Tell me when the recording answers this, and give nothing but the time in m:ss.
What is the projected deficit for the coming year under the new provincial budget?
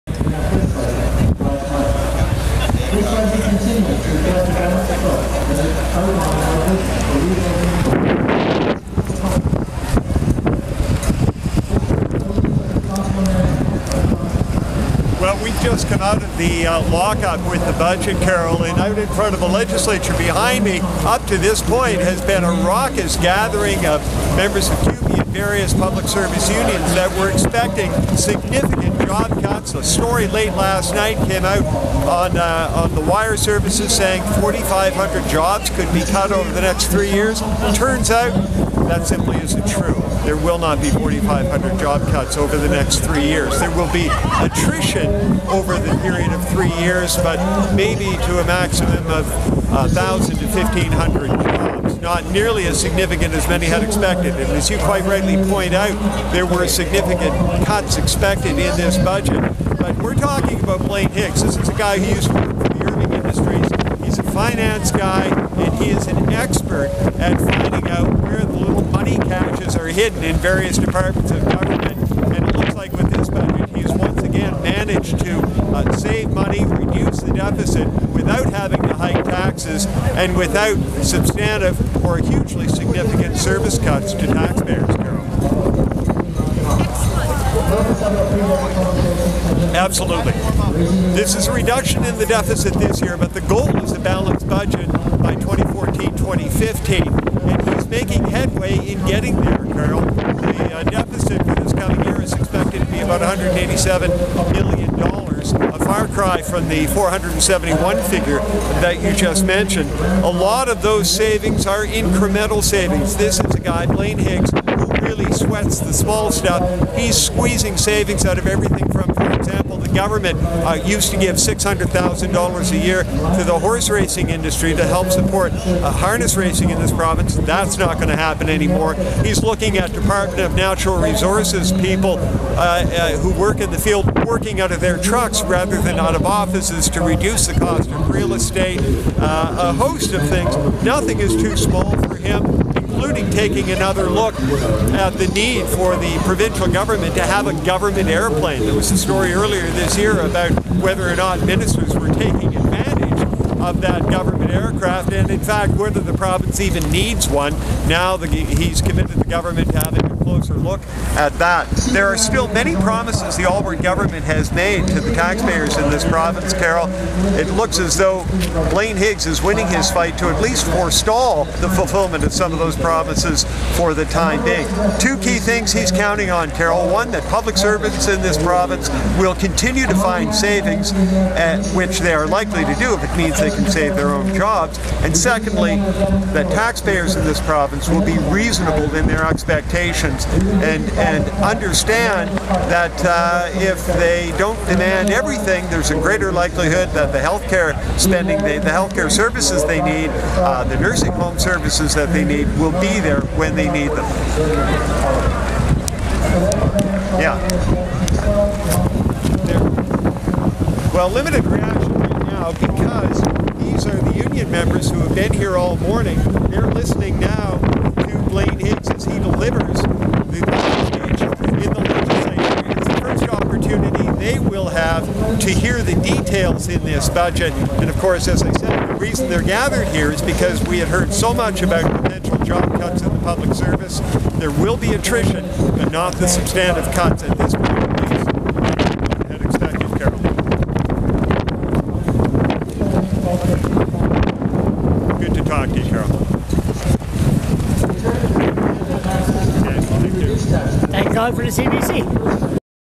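1:43.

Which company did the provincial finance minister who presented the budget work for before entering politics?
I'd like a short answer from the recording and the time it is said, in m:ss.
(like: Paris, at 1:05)
Irving Industries, at 1:02.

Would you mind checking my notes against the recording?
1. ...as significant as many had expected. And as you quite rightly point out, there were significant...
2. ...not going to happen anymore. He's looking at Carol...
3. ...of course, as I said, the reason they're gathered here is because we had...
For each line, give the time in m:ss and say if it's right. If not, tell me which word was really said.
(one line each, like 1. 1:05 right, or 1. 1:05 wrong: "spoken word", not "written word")
1. 0:52 right
2. 2:07 wrong: "Department", not "Carol"
3. 3:47 right.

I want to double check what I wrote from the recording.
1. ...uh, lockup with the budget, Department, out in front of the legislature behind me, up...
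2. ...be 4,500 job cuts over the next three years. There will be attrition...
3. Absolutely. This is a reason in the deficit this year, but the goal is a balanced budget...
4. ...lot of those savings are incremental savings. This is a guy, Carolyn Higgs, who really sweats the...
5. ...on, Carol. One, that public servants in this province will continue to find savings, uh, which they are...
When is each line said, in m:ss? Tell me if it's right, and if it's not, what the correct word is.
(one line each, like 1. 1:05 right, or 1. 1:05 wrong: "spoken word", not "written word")
1. 0:16 wrong: "Carolyn", not "Department"
2. 0:40 right
3. 1:29 wrong: "reduction", not "reason"
4. 1:50 wrong: "Blaine", not "Carolyn"
5. 2:56 right.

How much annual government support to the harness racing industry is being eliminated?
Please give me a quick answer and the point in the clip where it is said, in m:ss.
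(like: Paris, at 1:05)
$600,000, at 2:01.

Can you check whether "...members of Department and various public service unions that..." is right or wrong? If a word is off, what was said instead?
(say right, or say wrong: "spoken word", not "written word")
wrong: "CUPE", not "Department".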